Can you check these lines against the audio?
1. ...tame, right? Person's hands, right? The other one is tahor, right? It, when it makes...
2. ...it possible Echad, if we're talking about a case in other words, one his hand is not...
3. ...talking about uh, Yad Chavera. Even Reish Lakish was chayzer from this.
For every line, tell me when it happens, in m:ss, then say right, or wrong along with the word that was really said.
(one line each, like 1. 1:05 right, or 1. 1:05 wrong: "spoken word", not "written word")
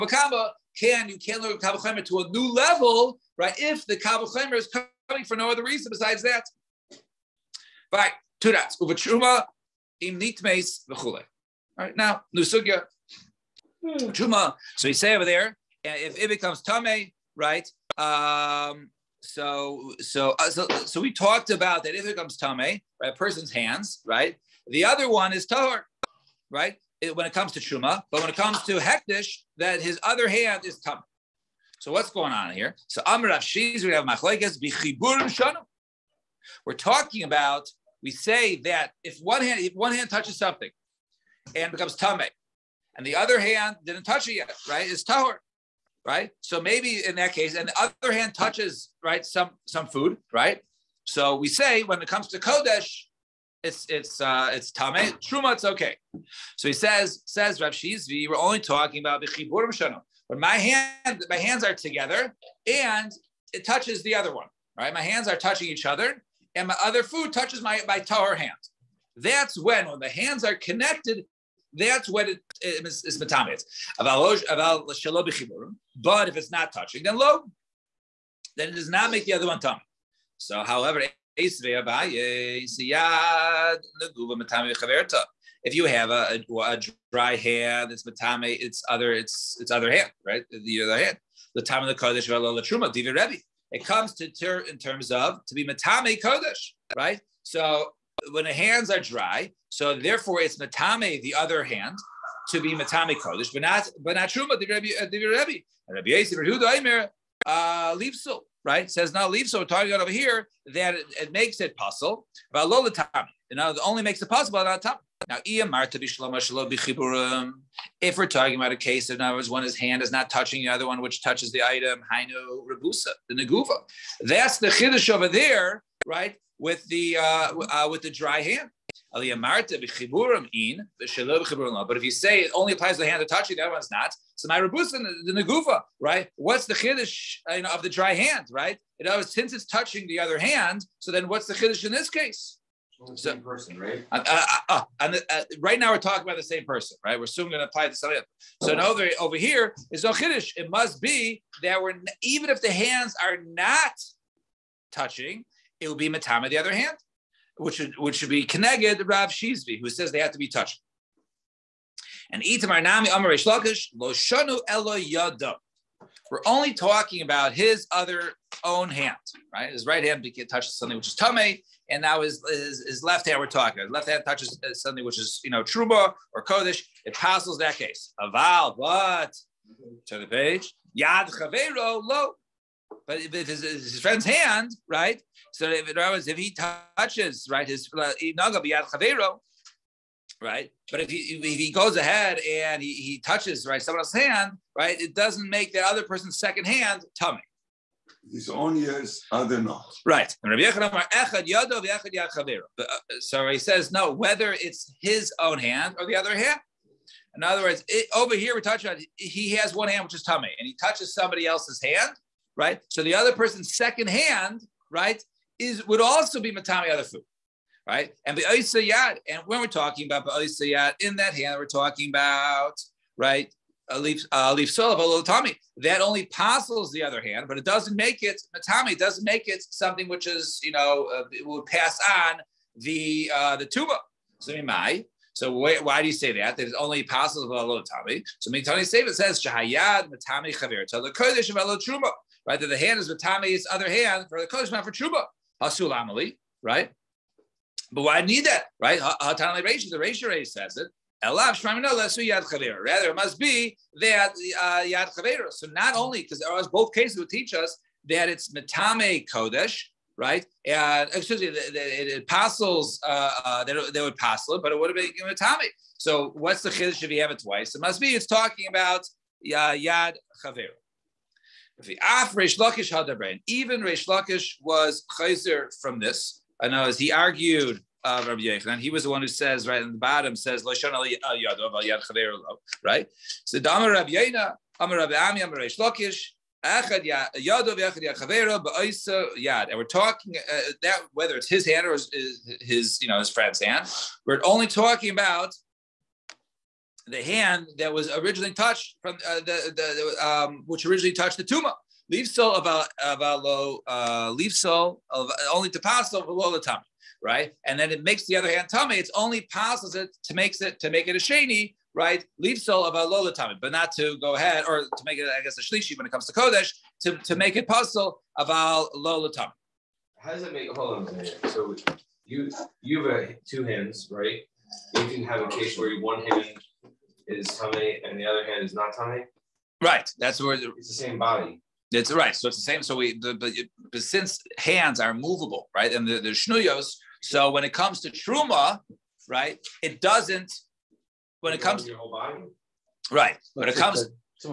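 1. 0:22 wrong: "comes", not "makes"
2. 1:54 wrong: "Now", not "Echad"
3. 4:28 right.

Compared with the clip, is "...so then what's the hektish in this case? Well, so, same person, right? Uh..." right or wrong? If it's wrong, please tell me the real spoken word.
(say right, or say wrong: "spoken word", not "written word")
wrong: "chiddush", not "hektish".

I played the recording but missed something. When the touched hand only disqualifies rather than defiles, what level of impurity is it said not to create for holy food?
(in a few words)
Shlishi.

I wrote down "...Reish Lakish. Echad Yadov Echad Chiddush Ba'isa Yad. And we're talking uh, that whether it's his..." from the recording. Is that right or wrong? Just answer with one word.
wrong.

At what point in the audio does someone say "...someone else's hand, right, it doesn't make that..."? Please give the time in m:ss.
3:13.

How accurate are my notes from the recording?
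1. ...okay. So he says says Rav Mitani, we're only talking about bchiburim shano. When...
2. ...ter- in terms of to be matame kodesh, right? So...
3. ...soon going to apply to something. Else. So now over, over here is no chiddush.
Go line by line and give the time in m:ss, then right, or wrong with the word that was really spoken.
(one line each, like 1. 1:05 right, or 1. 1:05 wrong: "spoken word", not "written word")
1. 0:55 wrong: "Shizvi", not "Mitani"
2. 1:34 right
3. 2:27 right.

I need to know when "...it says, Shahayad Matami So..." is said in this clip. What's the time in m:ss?
3:58.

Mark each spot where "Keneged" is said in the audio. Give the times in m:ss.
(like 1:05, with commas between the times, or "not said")
2:38.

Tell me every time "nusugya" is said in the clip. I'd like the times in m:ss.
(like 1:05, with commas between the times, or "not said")
0:12.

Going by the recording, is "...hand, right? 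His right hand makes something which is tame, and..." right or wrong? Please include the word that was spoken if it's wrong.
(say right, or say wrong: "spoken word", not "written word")
wrong: "touches", not "makes".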